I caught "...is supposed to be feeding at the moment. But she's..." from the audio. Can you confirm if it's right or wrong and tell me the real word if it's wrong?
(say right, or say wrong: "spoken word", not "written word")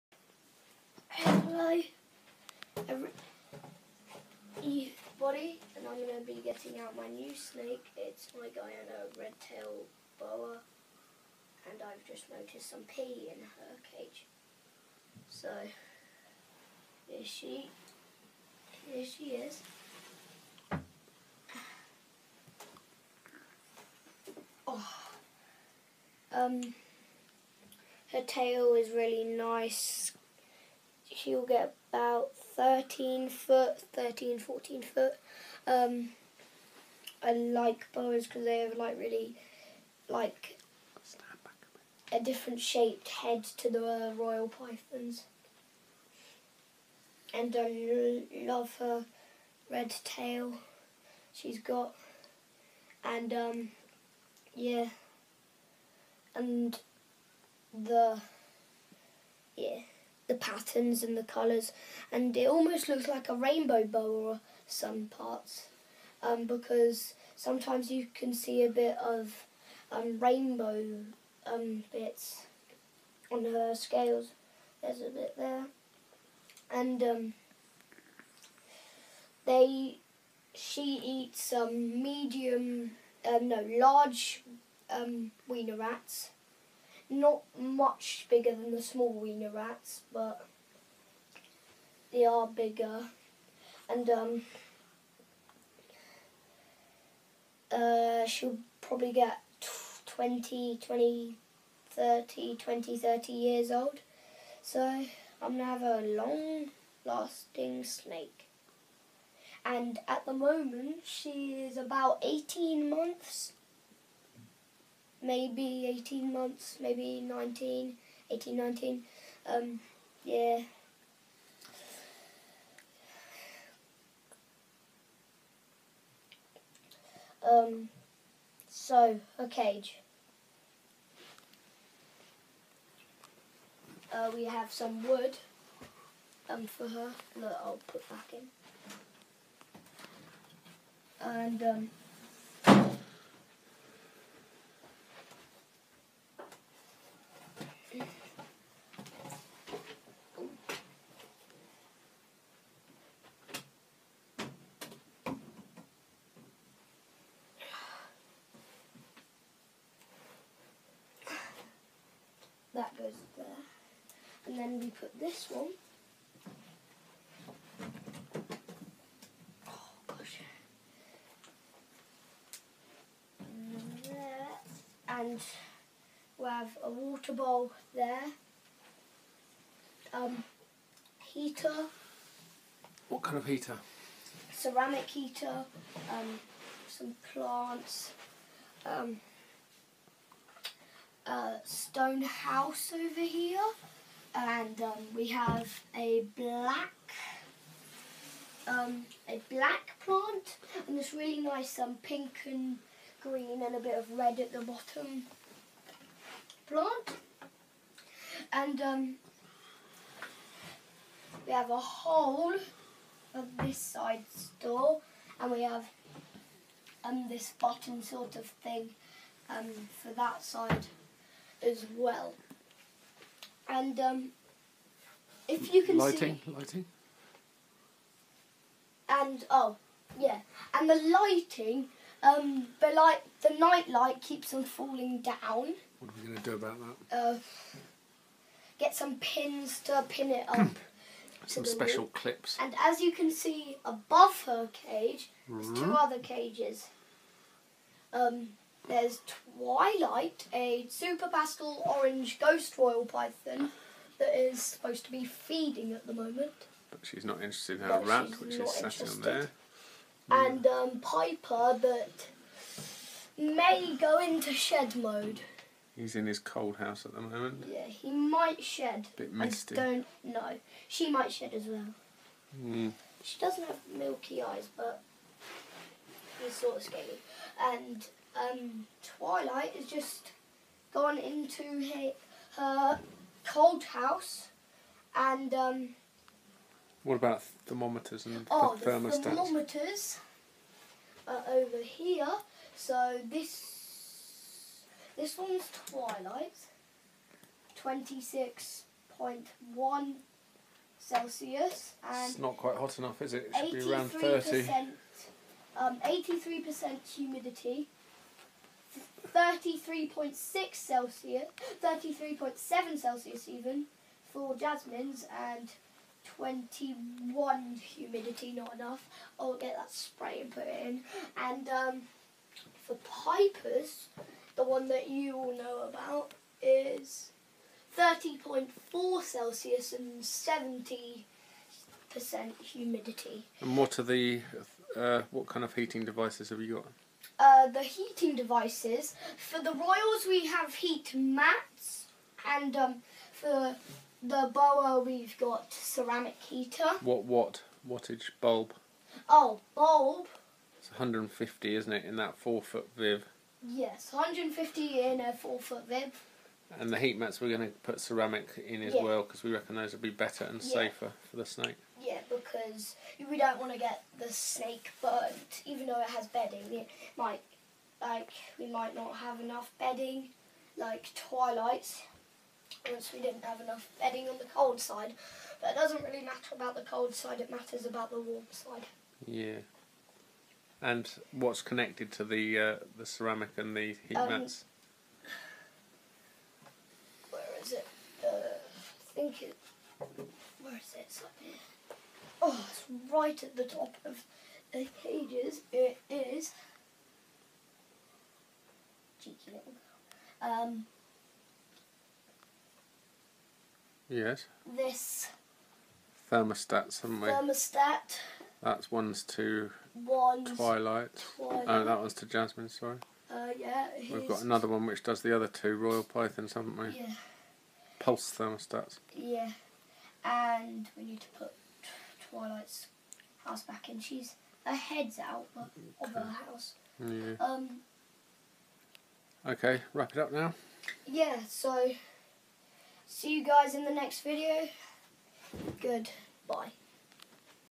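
right.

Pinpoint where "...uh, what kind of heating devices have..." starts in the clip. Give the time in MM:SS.
05:34.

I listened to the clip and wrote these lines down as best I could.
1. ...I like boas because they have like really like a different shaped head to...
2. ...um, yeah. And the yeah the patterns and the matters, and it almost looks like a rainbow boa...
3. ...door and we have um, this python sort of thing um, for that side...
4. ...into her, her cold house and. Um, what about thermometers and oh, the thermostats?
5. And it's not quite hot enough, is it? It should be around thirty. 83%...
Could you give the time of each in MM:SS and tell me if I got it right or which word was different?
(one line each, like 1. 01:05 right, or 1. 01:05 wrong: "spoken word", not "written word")
1. 00:37 right
2. 00:53 wrong: "colours", not "matters"
3. 03:34 wrong: "button", not "python"
4. 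04:41 right
5. 05:02 right.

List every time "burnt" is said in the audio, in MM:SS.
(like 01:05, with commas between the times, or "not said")
06:05.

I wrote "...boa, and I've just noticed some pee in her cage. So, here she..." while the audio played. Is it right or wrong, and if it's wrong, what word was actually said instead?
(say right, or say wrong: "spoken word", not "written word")
right.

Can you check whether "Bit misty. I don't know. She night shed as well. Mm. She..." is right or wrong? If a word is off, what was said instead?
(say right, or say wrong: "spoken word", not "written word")
wrong: "might", not "night".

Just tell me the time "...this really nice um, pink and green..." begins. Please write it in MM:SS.
03:20.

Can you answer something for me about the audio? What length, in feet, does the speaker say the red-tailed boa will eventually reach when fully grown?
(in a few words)
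13 to 14 feet.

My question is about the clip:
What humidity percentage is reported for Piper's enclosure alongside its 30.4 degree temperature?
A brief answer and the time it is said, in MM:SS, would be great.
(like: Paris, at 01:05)
70%, at 05:30.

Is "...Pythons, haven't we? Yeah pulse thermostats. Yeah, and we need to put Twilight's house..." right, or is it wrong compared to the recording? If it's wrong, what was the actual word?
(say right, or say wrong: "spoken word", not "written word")
right.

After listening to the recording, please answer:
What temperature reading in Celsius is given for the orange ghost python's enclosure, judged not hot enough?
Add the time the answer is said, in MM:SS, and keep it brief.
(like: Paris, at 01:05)
26.1 Celsius, at 04:57.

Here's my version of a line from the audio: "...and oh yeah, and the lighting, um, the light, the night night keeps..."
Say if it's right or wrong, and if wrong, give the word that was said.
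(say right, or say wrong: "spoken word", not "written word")
wrong: "light", not "night".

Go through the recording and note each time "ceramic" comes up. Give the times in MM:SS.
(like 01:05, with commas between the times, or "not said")
03:04, 05:45, 05:57, 06:23.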